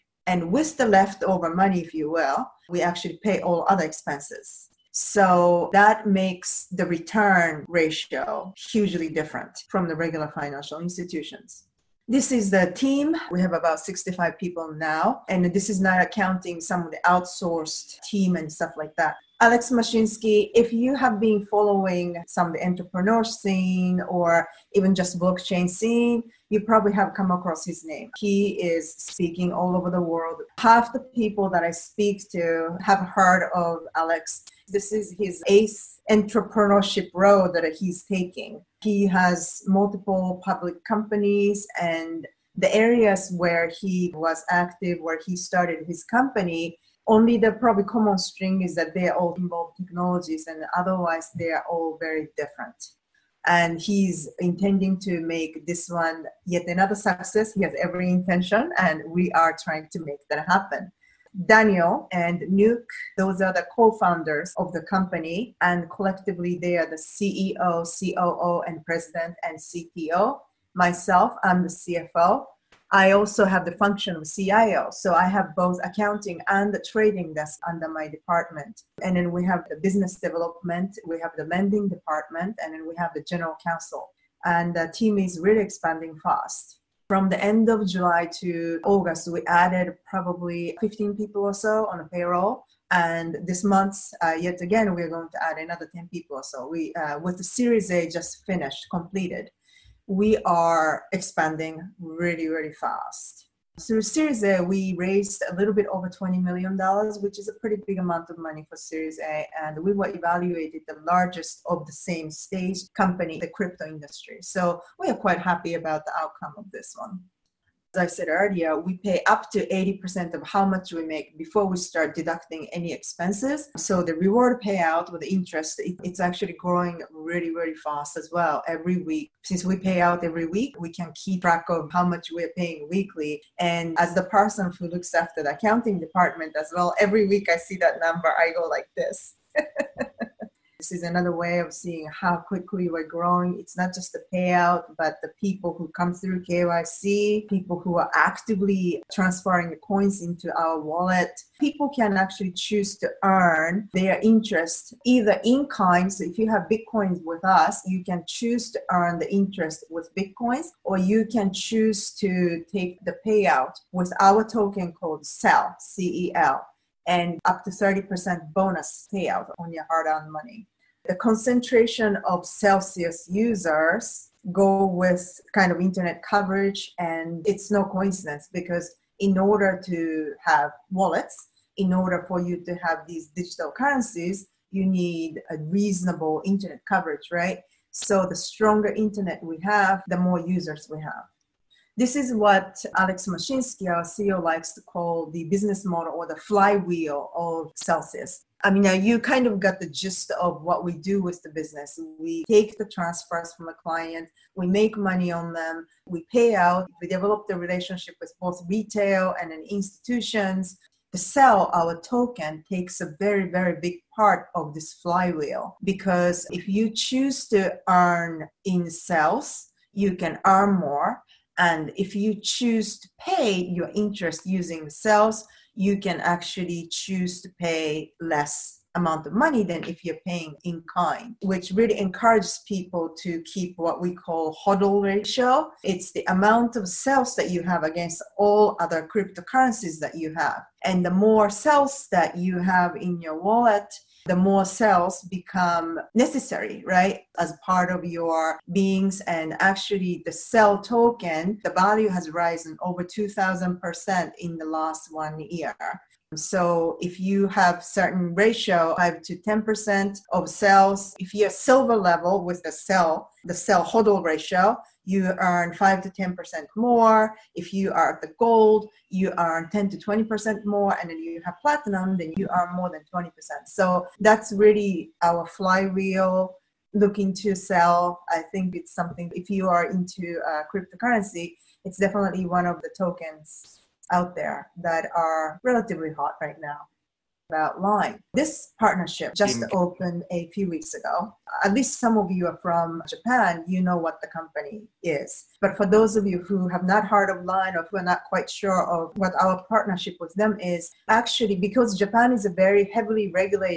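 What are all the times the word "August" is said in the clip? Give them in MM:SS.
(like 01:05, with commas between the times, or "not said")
01:28.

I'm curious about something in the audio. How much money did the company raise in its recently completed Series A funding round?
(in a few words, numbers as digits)
a little over $20 million.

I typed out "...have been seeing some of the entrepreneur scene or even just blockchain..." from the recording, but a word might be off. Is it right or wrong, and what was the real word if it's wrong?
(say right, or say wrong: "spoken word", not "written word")
wrong: "following", not "seeing".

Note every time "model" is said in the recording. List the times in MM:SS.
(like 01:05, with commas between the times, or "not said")
03:15.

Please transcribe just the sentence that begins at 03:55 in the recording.
It's the amount of sales that you have against all other cryptocurrencies that you have.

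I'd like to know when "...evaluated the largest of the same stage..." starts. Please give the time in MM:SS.
01:50.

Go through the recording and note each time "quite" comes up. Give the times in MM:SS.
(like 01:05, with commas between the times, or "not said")
01:55, 04:58.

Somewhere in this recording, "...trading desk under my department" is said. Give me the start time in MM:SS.
01:16.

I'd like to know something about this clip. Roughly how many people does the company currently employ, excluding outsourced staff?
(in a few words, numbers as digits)
65.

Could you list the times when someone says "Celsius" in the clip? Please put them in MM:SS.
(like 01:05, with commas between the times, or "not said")
02:52, 03:17.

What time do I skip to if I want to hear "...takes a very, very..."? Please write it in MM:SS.
03:32.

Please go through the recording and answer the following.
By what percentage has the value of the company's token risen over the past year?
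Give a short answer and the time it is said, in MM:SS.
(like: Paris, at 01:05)
over 2,000%, at 04:12.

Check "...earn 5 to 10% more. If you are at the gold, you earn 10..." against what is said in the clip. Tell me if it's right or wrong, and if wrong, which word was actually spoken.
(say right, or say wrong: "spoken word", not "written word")
right.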